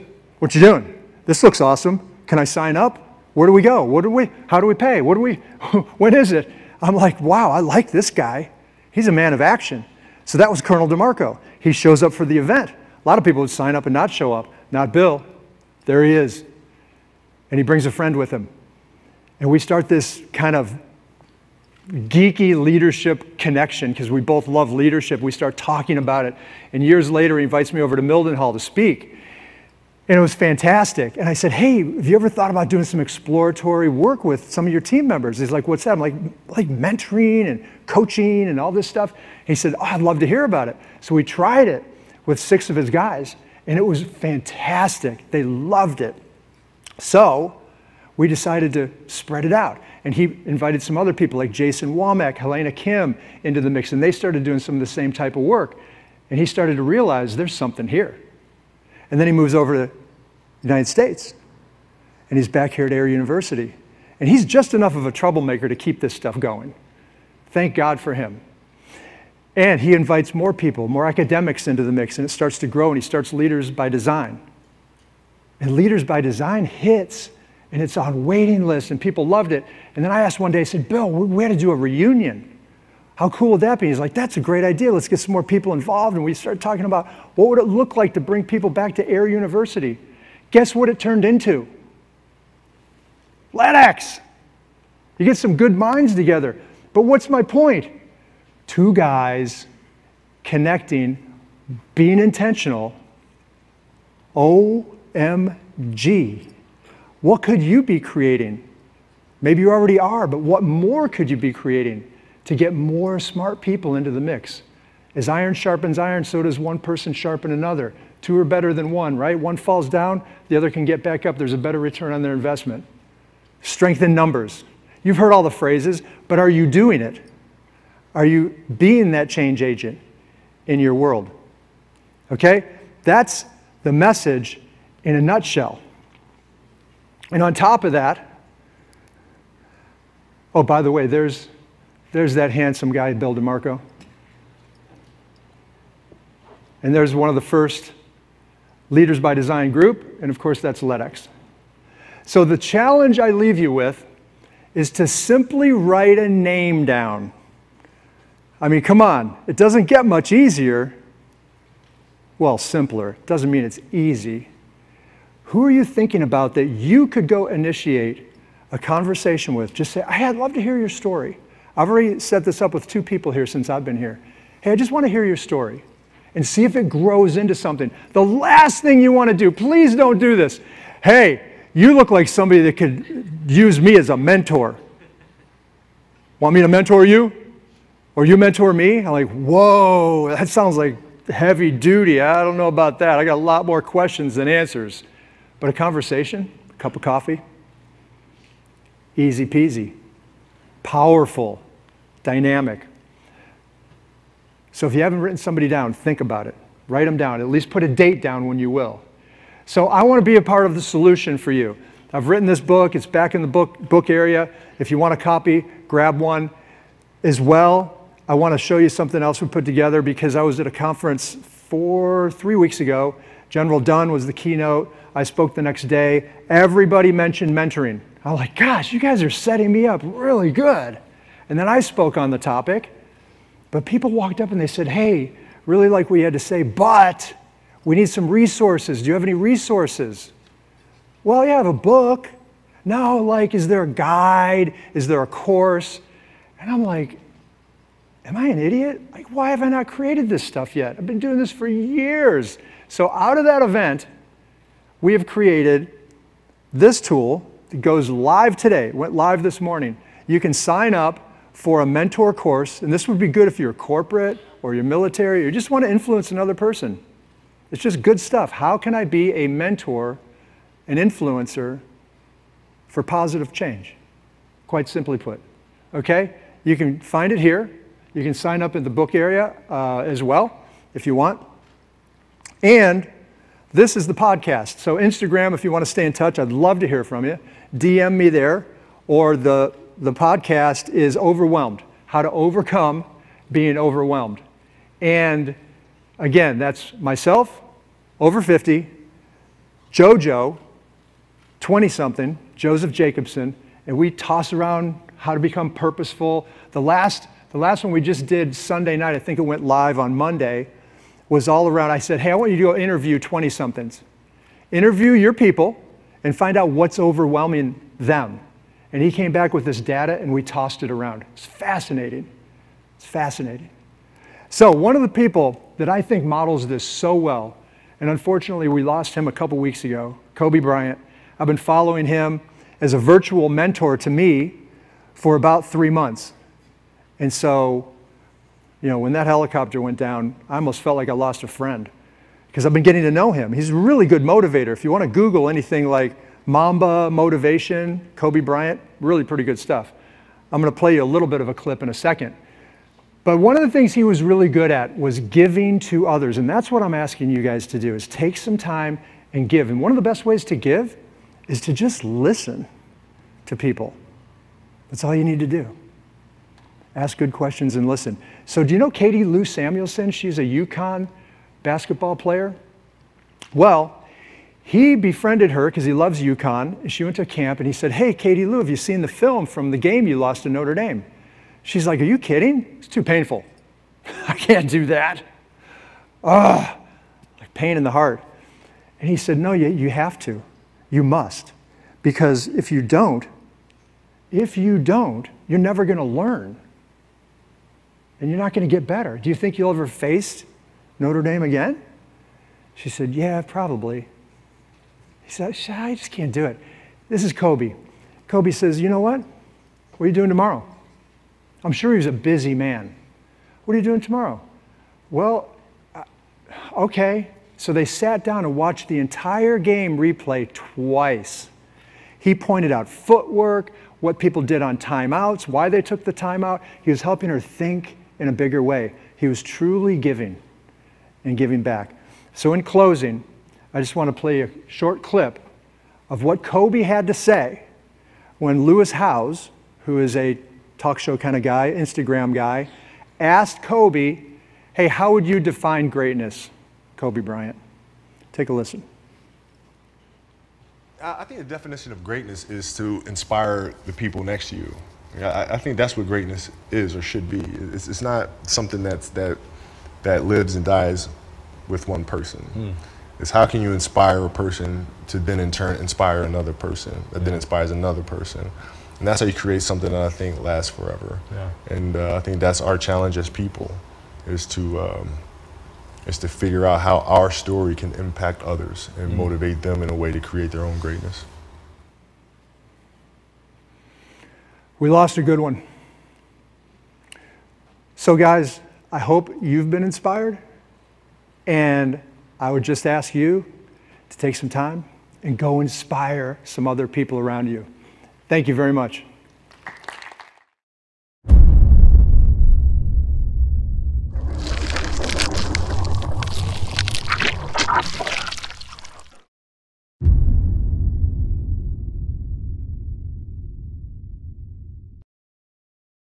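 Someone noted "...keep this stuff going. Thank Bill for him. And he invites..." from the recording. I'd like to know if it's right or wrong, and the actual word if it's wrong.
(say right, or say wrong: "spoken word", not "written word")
wrong: "God", not "Bill".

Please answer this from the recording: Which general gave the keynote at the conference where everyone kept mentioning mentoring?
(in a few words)
General Dunn.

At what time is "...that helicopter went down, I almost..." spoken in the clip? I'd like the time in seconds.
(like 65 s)
339 s.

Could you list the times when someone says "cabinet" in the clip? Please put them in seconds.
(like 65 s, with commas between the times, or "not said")
not said.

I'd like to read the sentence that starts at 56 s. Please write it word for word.
And he started to realize there's something here and then he moves over to the United States.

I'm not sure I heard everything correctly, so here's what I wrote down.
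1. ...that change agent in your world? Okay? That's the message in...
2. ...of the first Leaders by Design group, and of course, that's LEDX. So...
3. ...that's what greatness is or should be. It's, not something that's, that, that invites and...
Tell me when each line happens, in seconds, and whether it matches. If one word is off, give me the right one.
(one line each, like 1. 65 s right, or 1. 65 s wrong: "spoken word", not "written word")
1. 129 s right
2. 147 s right
3. 455 s wrong: "lives", not "invites".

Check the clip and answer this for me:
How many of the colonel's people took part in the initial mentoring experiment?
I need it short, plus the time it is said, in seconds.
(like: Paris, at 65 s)
6, at 42 s.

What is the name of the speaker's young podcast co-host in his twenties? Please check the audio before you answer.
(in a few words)
Joseph Jacobson.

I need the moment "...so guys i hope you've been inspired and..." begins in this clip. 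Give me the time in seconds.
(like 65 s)
487 s.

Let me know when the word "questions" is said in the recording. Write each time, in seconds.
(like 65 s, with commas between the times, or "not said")
193 s, 367 s.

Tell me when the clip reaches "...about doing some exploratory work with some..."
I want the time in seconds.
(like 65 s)
32 s.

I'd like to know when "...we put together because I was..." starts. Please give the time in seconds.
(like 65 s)
219 s.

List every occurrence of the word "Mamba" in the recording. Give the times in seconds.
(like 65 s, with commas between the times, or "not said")
346 s.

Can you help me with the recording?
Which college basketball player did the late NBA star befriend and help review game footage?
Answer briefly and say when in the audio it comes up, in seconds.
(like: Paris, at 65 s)
Katie Lou Samuelson, at 368 s.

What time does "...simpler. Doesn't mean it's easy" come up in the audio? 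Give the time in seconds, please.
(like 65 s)
162 s.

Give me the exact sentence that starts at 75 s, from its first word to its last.
And Leaders by Design hits, and it's on waiting lists, and people loved it.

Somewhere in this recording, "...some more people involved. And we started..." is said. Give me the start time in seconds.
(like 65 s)
85 s.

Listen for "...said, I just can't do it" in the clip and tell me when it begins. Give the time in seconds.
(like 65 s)
405 s.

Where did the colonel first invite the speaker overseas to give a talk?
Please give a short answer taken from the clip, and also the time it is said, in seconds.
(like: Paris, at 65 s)
Mildenhall, at 28 s.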